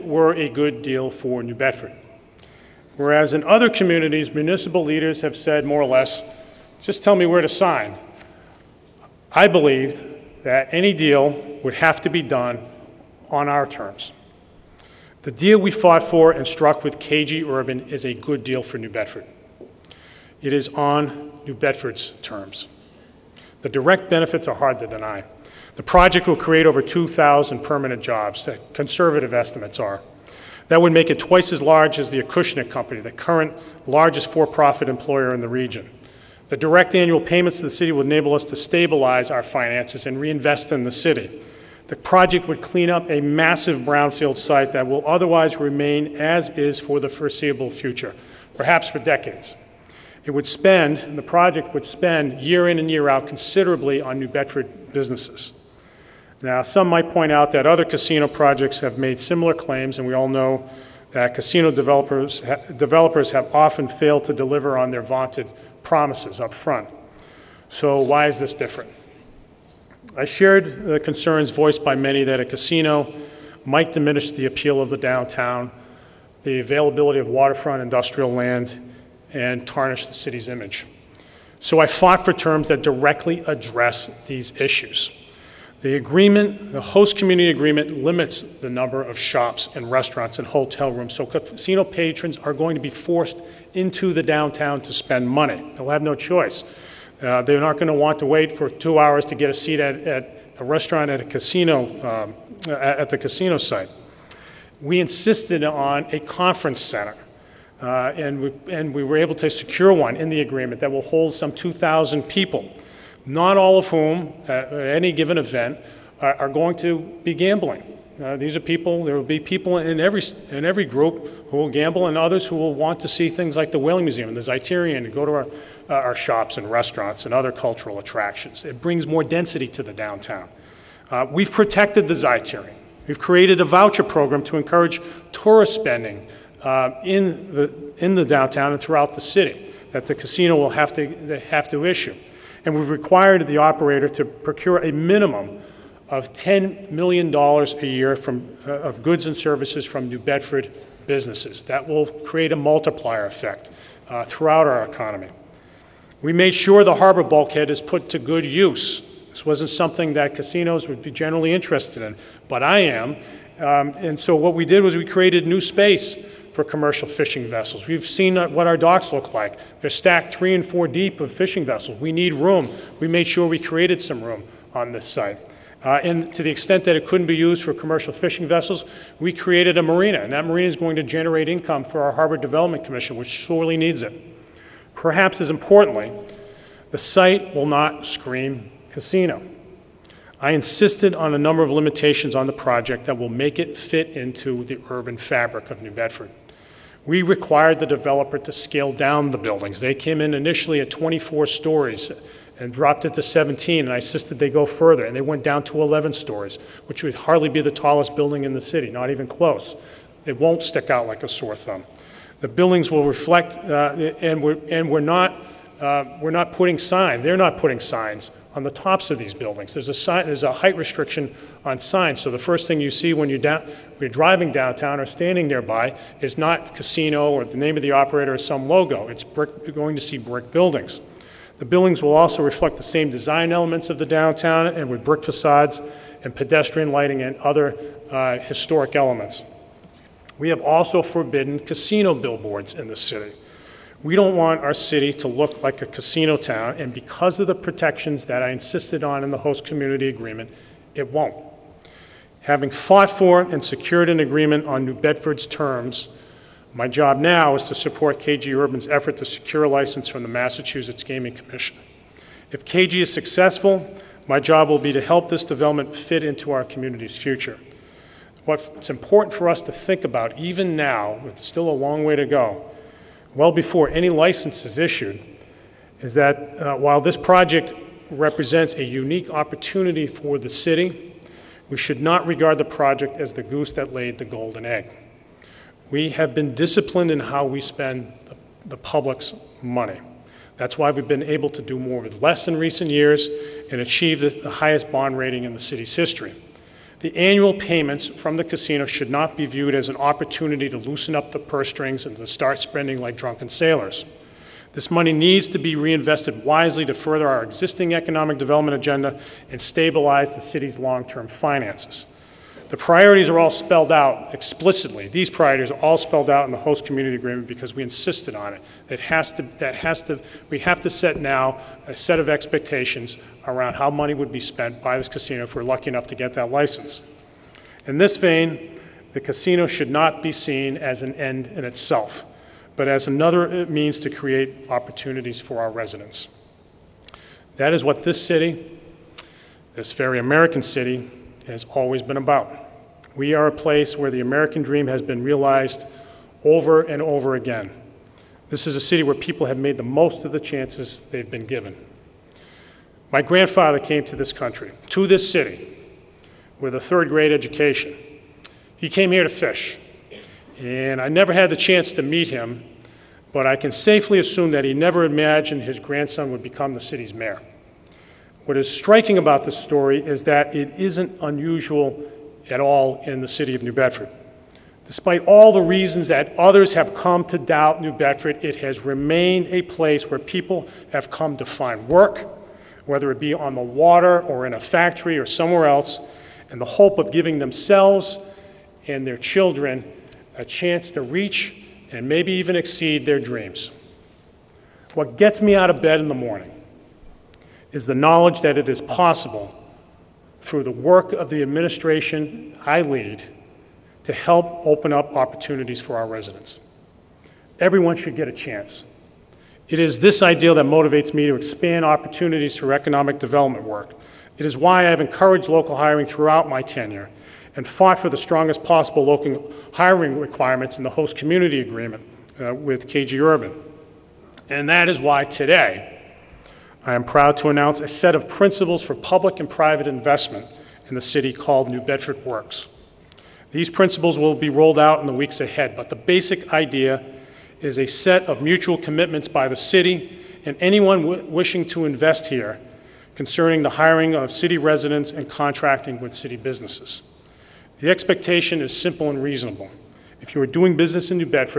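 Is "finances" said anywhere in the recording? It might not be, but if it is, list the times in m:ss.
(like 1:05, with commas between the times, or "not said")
0:39, 5:11.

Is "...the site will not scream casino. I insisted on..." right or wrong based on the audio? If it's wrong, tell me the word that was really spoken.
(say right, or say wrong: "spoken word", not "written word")
right.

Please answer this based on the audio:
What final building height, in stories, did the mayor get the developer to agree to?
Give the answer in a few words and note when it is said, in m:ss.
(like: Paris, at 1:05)
11 stories, at 3:25.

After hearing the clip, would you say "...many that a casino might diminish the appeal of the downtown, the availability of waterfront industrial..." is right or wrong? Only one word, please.
right.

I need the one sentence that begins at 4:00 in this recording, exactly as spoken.
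We have also forbidden casino billboards in the city.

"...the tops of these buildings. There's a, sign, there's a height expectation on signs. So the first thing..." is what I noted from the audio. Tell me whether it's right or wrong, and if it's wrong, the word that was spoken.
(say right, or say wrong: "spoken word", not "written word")
wrong: "restriction", not "expectation".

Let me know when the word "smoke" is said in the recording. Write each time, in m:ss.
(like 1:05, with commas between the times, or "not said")
not said.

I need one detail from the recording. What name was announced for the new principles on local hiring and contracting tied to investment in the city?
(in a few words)
New Bedford Works.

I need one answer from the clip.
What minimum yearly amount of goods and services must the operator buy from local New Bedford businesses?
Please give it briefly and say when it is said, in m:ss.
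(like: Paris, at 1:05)
$10 million, at 2:26.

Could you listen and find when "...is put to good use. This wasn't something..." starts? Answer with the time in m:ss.
2:37.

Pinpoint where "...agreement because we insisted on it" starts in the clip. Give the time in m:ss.
5:17.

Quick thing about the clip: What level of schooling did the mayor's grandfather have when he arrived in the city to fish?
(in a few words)
third grade.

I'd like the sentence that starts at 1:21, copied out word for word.
So I fought for terms that directly address these issues.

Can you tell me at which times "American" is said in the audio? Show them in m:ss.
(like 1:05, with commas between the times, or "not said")
5:40, 5:44.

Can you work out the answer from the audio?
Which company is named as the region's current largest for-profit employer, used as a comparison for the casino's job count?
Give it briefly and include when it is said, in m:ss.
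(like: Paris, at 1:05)
Acushnet Company, at 0:32.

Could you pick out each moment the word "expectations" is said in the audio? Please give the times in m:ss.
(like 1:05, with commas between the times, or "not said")
5:22, 7:27.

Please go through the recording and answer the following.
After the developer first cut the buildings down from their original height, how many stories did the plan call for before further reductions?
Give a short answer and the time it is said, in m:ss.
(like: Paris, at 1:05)
17, at 3:23.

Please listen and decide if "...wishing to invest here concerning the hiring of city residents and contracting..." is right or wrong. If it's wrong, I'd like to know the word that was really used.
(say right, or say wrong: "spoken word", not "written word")
right.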